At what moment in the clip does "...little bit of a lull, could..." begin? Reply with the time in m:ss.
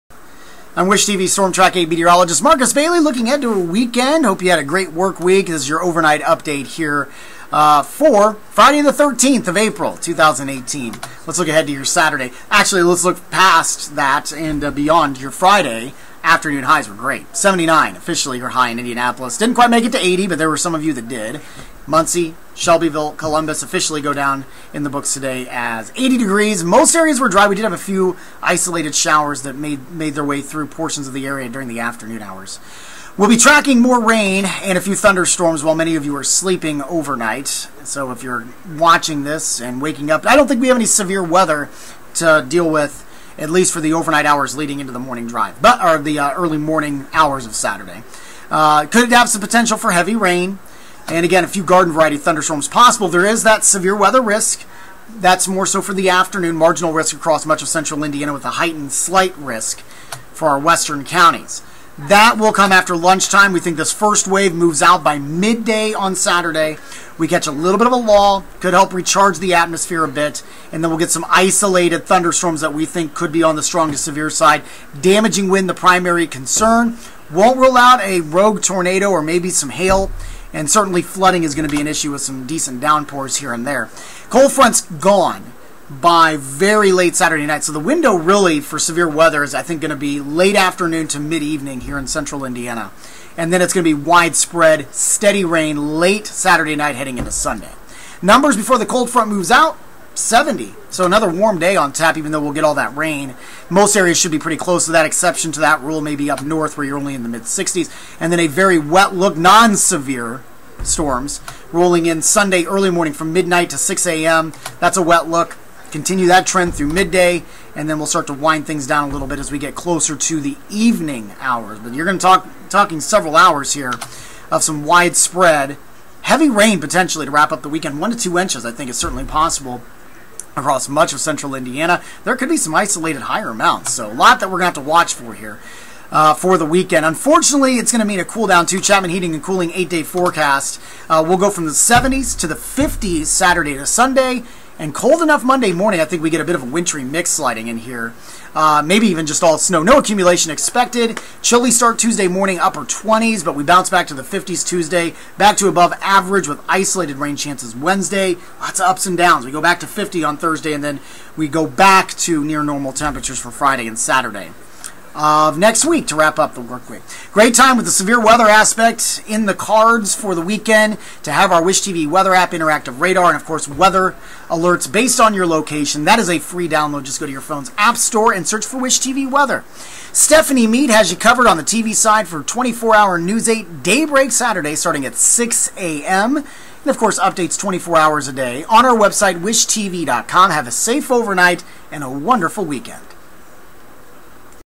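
1:07.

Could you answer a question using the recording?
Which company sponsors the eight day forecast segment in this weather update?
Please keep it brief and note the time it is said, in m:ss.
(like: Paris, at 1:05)
Chapman Heating and Cooling, at 2:18.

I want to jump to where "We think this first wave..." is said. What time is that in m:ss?
1:03.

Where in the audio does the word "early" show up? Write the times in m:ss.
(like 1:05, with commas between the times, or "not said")
0:46, 1:52.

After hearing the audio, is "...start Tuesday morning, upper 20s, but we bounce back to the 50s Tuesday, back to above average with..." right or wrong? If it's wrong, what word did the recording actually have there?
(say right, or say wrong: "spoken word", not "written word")
right.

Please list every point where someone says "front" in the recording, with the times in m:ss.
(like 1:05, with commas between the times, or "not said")
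1:24, 1:39.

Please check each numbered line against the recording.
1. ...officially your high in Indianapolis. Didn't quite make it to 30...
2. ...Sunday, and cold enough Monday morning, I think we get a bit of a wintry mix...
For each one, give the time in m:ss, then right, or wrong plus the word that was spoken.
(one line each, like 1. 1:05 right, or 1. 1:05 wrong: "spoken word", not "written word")
1. 0:17 wrong: "80", not "30"
2. 2:23 right.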